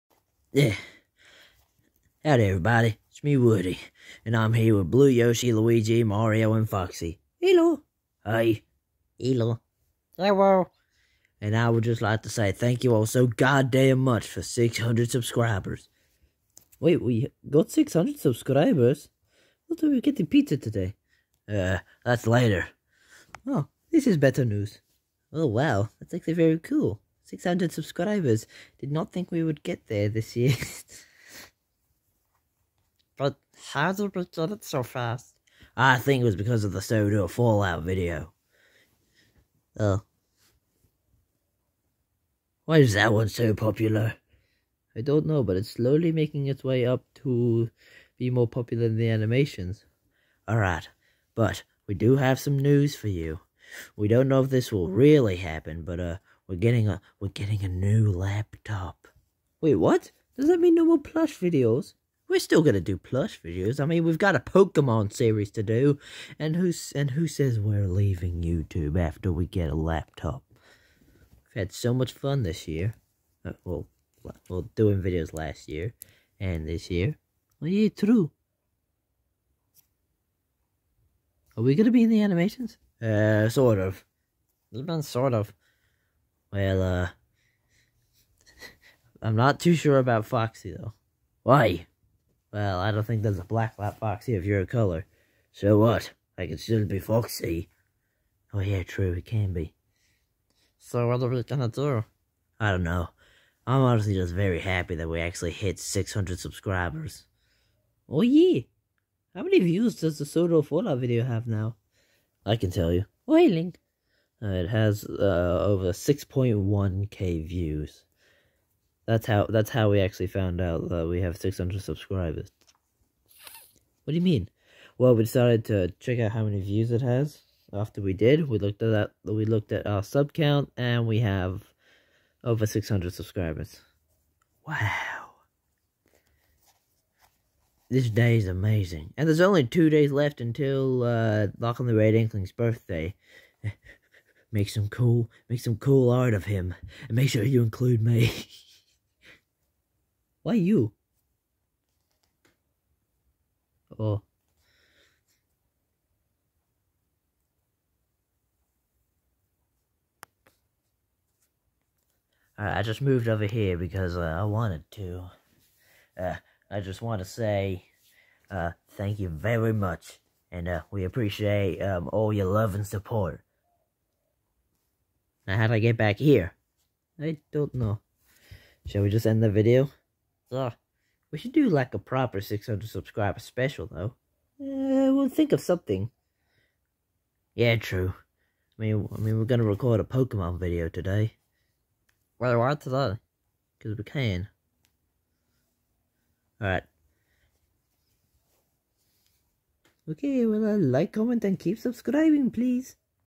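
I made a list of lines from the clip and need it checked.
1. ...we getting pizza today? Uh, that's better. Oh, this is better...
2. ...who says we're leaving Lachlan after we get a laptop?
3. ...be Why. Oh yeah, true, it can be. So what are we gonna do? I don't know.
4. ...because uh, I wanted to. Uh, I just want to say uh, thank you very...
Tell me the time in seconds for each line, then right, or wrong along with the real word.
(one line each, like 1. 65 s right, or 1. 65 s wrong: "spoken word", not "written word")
1. 19 s wrong: "later", not "better"
2. 67 s wrong: "YouTube", not "Lachlan"
3. 96 s wrong: "Foxy", not "Why"
4. 163 s right.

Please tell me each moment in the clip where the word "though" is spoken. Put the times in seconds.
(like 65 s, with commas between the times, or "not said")
90 s, 183 s.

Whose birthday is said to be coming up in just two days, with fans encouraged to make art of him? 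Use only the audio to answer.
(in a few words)
Lachlan the Red Inkling.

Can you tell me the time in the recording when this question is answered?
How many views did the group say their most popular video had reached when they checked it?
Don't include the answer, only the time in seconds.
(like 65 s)
115 s.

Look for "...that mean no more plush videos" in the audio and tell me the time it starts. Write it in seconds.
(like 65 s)
60 s.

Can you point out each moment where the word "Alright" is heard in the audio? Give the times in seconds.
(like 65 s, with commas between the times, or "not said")
50 s, 196 s.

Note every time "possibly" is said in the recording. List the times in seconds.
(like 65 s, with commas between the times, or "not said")
not said.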